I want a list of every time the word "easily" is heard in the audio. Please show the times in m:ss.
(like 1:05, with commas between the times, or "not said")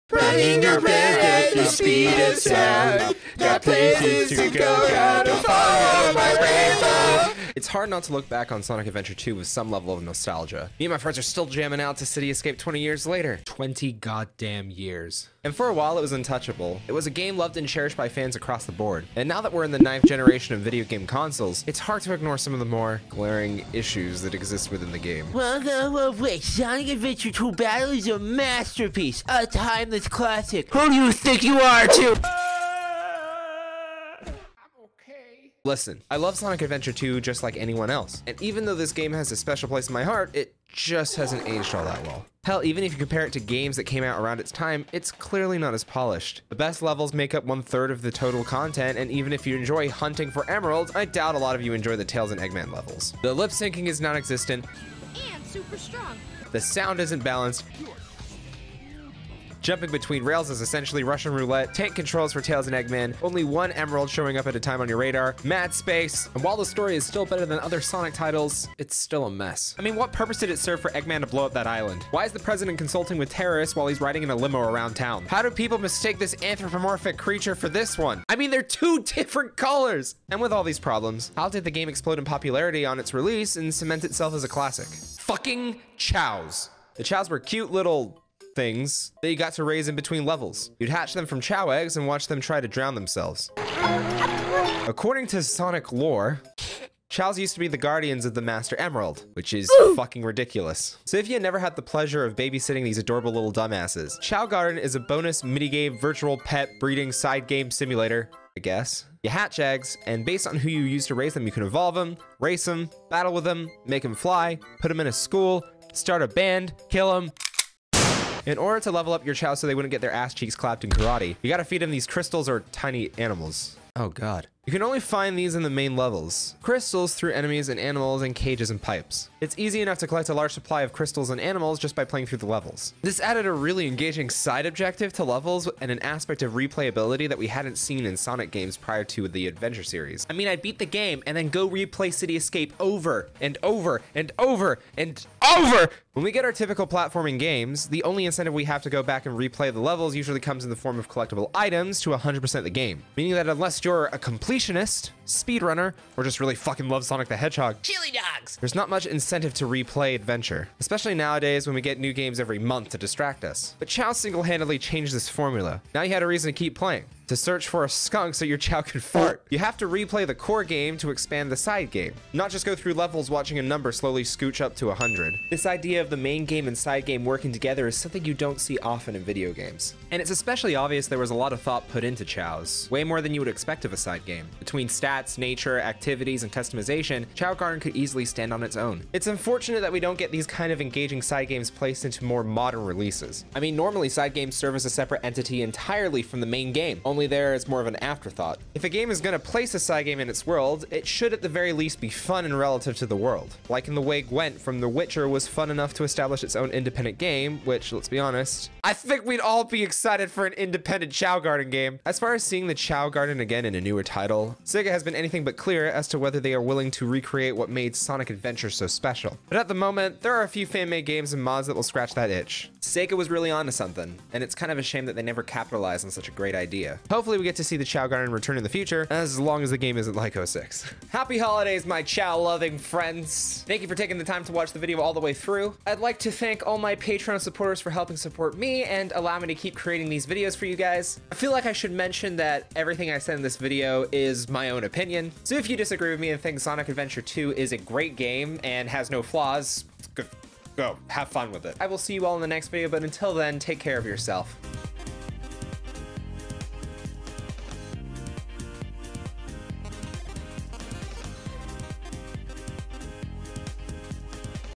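3:07.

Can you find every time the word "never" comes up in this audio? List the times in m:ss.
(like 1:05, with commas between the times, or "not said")
1:41, 3:45.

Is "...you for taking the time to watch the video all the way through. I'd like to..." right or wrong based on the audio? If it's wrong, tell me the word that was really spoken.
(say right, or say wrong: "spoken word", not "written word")
right.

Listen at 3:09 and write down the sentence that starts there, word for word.
It's unfortunate that we don't get these kind of engaging side games placed into more modern releases.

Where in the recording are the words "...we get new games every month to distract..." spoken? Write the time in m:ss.
2:41.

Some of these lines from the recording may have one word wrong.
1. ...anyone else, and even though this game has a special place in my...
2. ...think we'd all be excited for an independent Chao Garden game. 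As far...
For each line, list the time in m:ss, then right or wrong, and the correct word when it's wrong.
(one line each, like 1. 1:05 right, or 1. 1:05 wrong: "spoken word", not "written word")
1. 0:37 right
2. 3:28 right.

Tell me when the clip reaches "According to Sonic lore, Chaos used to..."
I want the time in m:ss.
1:34.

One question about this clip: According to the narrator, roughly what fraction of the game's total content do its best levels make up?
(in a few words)
One third.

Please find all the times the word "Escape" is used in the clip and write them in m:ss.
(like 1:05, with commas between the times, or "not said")
0:12, 2:22.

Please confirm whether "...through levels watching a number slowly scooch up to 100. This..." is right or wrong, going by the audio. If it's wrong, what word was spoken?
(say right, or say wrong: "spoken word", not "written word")
right.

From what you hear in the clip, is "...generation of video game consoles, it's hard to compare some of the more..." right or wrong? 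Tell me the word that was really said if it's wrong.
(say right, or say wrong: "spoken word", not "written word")
wrong: "ignore", not "compare".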